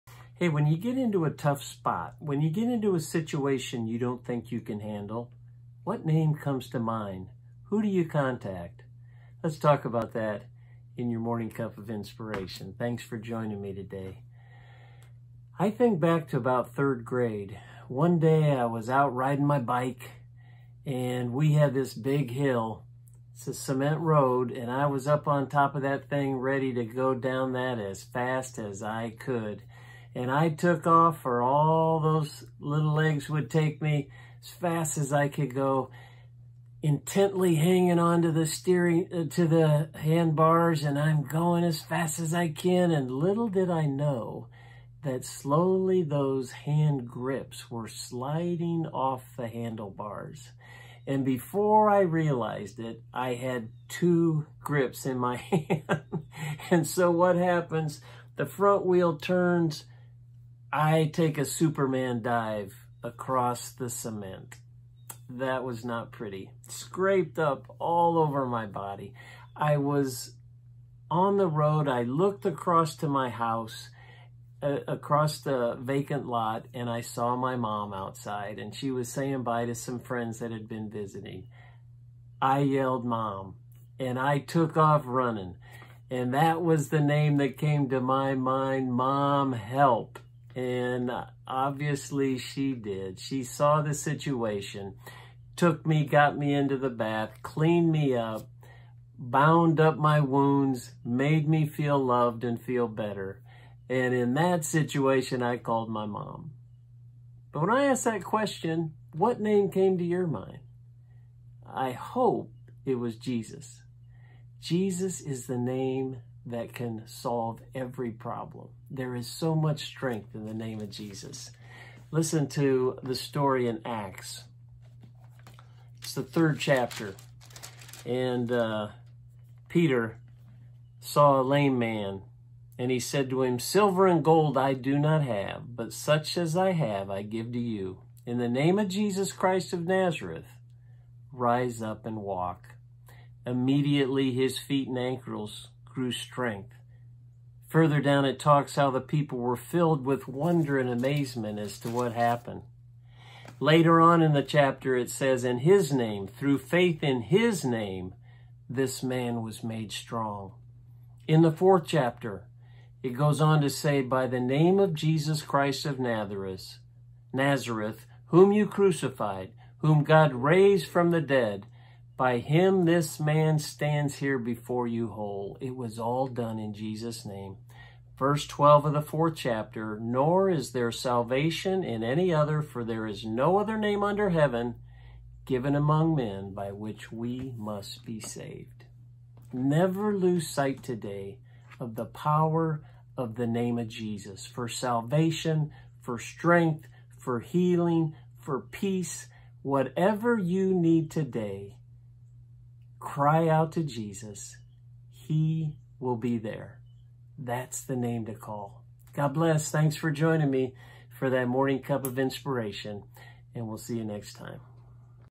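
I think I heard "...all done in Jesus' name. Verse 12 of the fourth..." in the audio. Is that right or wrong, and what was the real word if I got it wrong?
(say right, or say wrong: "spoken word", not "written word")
right.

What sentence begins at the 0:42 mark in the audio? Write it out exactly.
And little did I know that slowly those hand grips were sliding off the handlebars.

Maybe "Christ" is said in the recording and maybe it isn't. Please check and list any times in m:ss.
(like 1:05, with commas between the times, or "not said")
2:19, 2:45.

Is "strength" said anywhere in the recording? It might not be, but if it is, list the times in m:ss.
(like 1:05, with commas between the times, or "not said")
1:59, 2:26, 3:16.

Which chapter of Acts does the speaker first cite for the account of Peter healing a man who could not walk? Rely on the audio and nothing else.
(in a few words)
Third chapter.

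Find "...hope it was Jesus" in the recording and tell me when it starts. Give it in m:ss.
1:51.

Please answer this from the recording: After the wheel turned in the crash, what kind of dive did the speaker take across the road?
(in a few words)
Superman dive.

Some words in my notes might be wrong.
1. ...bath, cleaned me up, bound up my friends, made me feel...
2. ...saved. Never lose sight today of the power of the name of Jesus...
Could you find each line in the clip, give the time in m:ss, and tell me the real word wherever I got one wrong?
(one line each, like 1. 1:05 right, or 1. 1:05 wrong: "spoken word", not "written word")
1. 1:36 wrong: "wounds", not "friends"
2. 3:08 right.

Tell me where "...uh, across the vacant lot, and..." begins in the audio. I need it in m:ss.
1:14.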